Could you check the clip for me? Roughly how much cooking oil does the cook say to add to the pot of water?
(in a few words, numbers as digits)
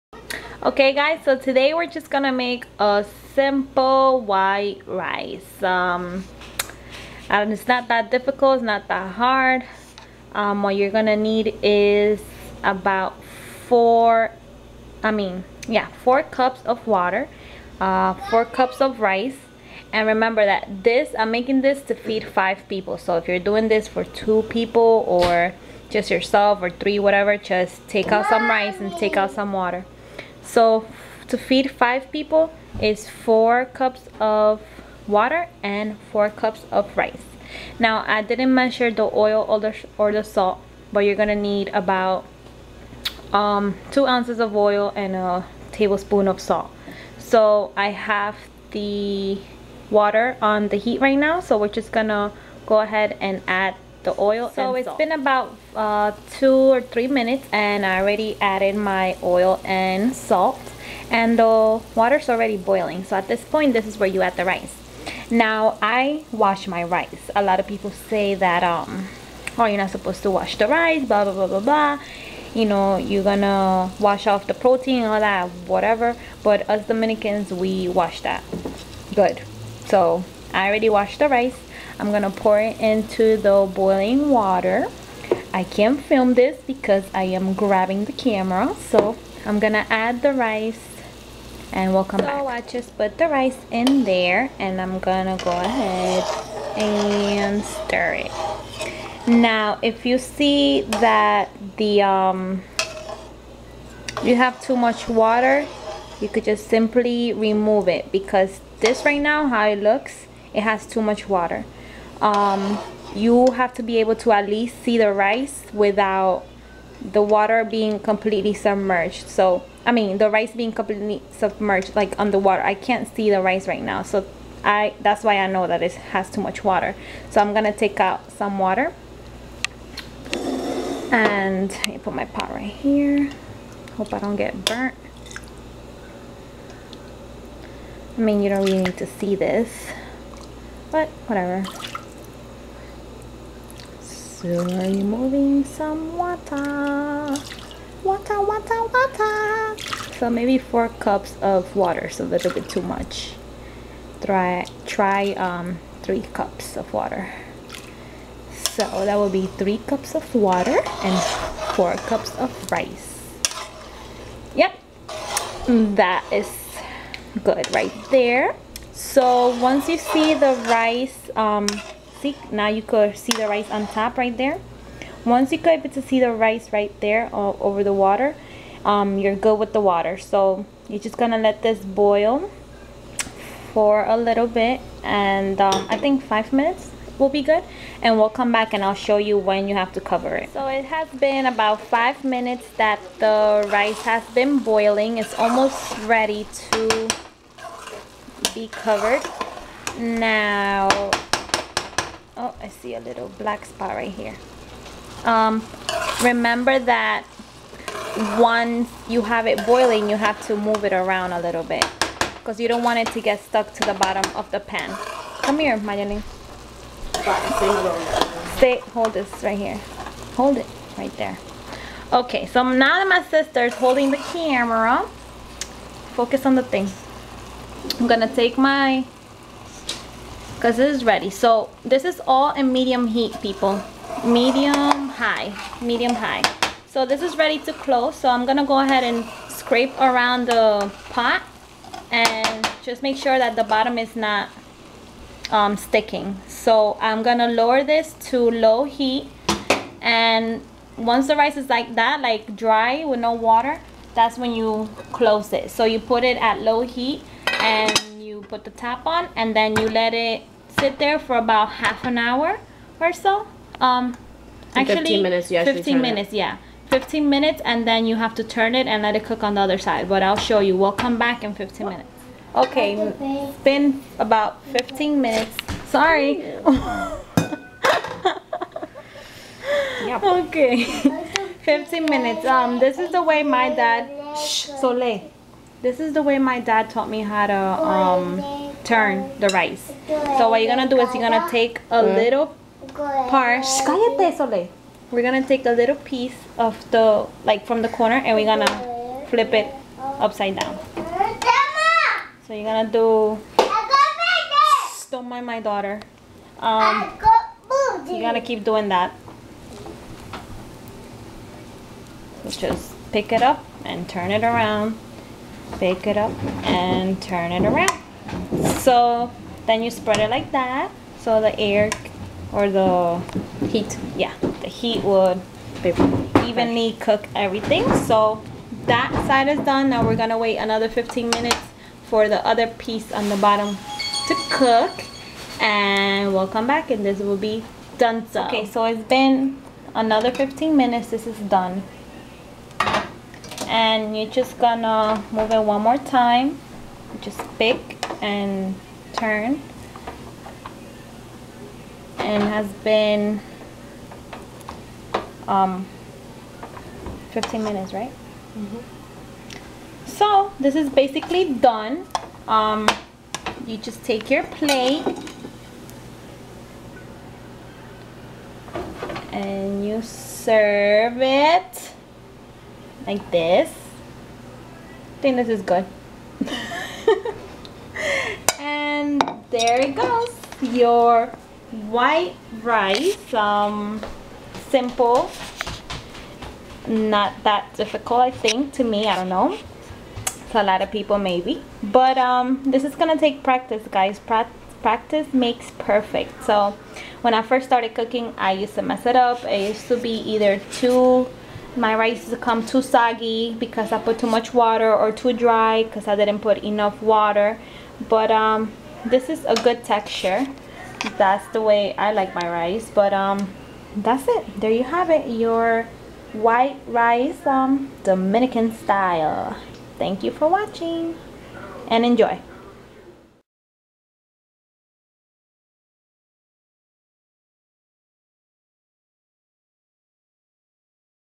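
2 ounces.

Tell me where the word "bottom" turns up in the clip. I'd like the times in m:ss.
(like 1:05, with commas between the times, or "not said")
3:33, 4:03, 5:33.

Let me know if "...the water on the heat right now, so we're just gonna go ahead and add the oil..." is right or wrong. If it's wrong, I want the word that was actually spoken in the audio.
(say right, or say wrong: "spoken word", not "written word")
right.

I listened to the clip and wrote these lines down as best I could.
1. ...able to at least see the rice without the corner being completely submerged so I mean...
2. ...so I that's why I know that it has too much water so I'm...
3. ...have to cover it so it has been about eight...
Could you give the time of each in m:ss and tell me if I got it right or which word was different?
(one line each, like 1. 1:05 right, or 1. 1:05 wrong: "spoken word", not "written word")
1. 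1:53 wrong: "water", not "corner"
2. 2:04 right
3. 3:09 wrong: "five", not "eight".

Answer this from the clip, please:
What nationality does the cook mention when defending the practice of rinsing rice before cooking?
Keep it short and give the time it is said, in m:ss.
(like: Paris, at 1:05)
Dominican, at 1:16.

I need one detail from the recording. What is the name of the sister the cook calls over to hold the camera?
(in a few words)
Mayaline.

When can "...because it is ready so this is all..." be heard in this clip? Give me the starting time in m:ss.
3:50.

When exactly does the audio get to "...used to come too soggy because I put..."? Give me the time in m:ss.
6:42.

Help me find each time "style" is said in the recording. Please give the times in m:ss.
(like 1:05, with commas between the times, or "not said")
6:58.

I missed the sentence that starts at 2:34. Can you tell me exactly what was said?
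Try, try um, three cups of water.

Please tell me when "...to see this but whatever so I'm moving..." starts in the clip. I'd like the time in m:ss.
2:18.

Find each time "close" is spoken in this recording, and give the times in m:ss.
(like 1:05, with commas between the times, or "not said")
3:57, 4:15.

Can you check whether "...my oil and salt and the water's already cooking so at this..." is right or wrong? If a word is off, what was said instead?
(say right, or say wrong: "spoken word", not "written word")
wrong: "boiling", not "cooking".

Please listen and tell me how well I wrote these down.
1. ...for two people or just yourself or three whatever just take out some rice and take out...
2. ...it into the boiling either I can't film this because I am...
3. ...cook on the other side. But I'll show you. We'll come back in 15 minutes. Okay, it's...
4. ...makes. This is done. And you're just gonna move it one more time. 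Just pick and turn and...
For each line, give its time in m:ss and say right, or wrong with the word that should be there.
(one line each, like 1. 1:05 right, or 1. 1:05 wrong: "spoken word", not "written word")
1. 0:23 right
2. 1:22 wrong: "water", not "either"
3. 4:29 right
4. 5:40 wrong: "minutes", not "makes".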